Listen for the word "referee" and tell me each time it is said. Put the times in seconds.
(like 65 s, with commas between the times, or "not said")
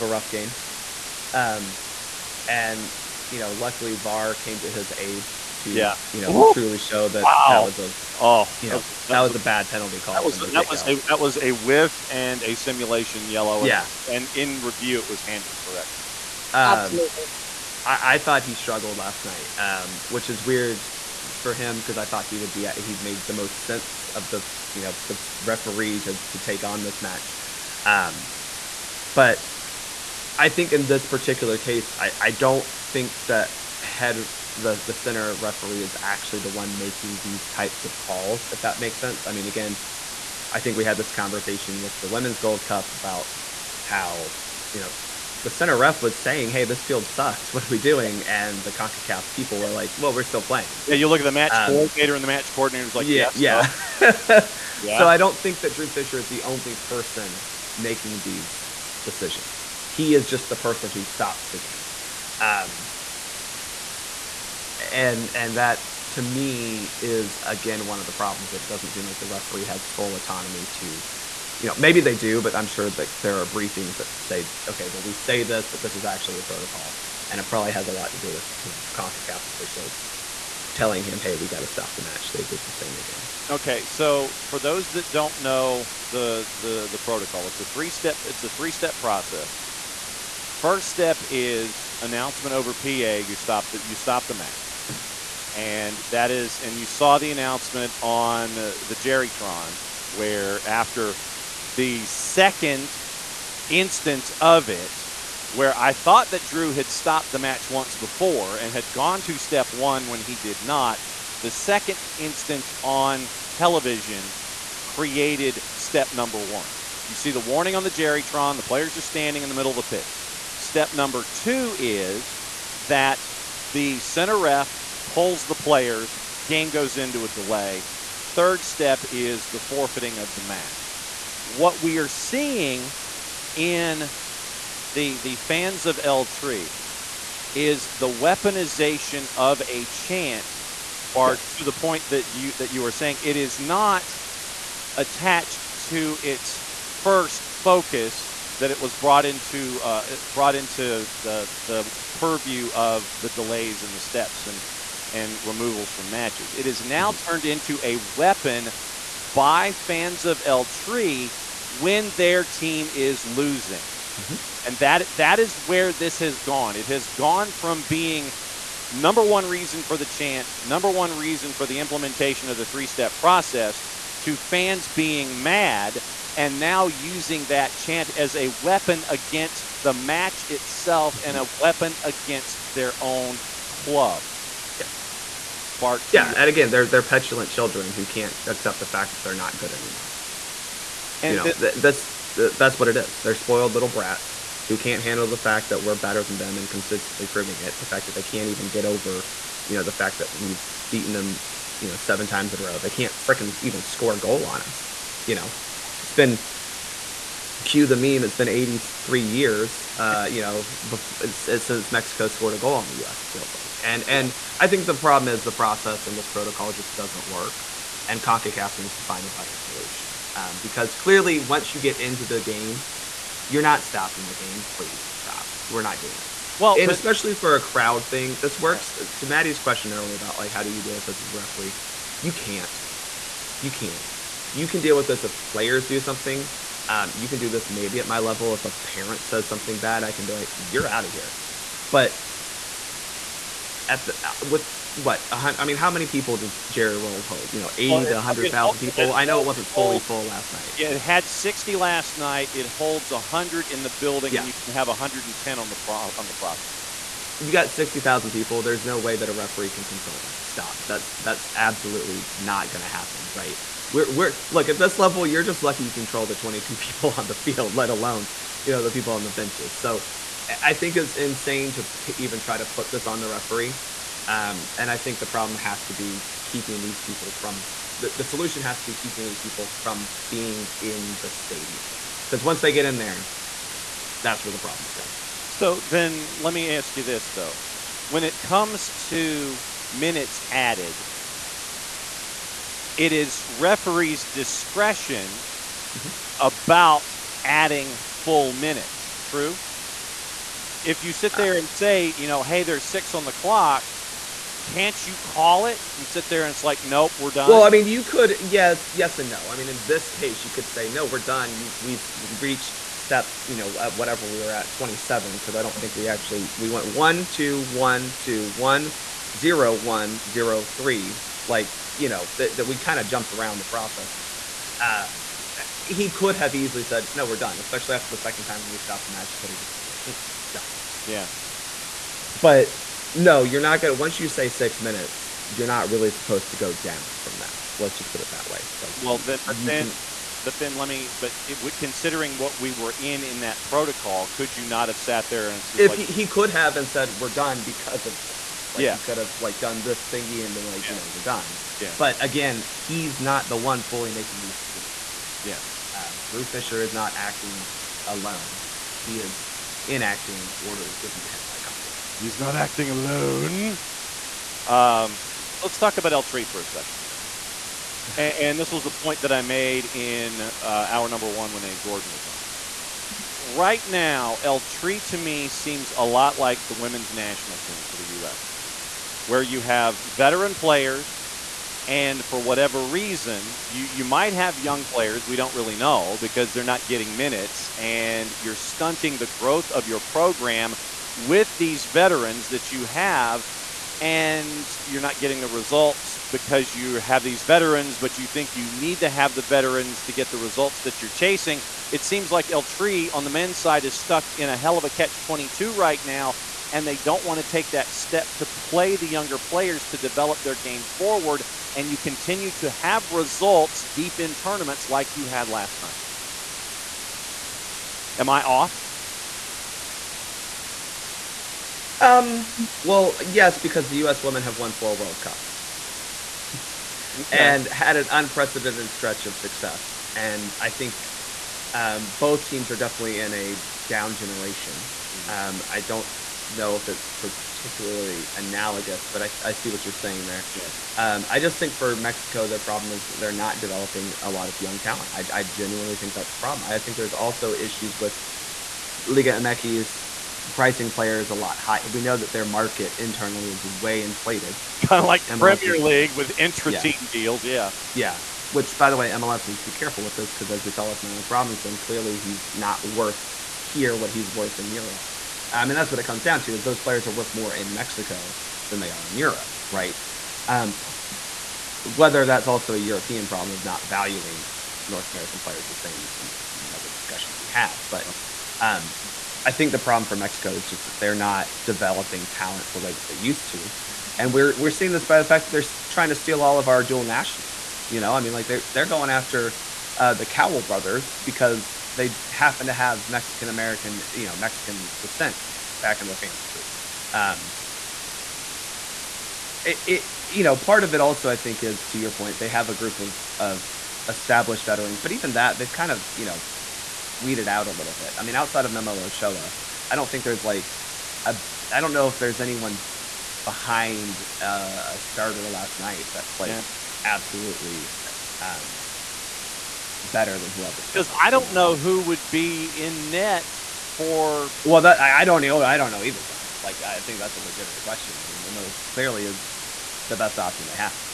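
25 s, 35 s, 69 s, 231 s, 259 s, 273 s, 293 s.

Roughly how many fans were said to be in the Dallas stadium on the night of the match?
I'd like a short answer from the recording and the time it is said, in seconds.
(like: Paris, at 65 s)
60,000, at 257 s.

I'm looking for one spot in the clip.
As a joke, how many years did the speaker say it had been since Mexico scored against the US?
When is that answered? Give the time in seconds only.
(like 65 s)
208 s.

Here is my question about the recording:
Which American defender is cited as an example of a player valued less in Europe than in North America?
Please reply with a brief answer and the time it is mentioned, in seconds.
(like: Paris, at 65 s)
Miles Robinson, at 461 s.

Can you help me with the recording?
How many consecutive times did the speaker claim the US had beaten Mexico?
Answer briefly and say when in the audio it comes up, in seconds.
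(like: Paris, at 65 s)
7, at 201 s.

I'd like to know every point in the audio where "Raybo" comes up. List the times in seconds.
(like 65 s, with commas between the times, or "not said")
not said.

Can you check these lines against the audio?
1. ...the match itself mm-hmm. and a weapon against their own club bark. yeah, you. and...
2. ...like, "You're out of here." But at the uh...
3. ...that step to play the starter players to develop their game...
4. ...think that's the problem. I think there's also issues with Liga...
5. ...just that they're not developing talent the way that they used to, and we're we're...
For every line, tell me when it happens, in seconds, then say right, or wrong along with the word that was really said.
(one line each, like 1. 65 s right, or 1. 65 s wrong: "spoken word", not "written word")
1. 179 s right
2. 240 s right
3. 407 s wrong: "younger", not "starter"
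4. 445 s right
5. 480 s right.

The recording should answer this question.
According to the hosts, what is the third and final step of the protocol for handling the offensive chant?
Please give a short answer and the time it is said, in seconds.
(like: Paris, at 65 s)
forfeiting of the match, at 129 s.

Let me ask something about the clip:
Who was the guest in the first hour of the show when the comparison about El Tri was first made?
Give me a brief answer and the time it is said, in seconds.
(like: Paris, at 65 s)
Abe Gordon, at 371 s.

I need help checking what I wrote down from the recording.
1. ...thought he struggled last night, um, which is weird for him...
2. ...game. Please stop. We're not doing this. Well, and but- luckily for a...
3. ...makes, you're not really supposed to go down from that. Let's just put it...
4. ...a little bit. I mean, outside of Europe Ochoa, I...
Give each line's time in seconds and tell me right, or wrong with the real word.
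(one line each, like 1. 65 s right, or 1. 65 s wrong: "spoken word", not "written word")
1. 18 s right
2. 224 s wrong: "especially", not "luckily"
3. 334 s wrong: "minutes", not "makes"
4. 507 s wrong: "Memo", not "Europe".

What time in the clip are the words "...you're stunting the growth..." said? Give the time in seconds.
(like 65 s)
388 s.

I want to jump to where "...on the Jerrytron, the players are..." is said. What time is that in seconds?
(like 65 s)
117 s.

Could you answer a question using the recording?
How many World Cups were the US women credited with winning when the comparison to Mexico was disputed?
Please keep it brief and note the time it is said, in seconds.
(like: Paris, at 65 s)
4, at 424 s.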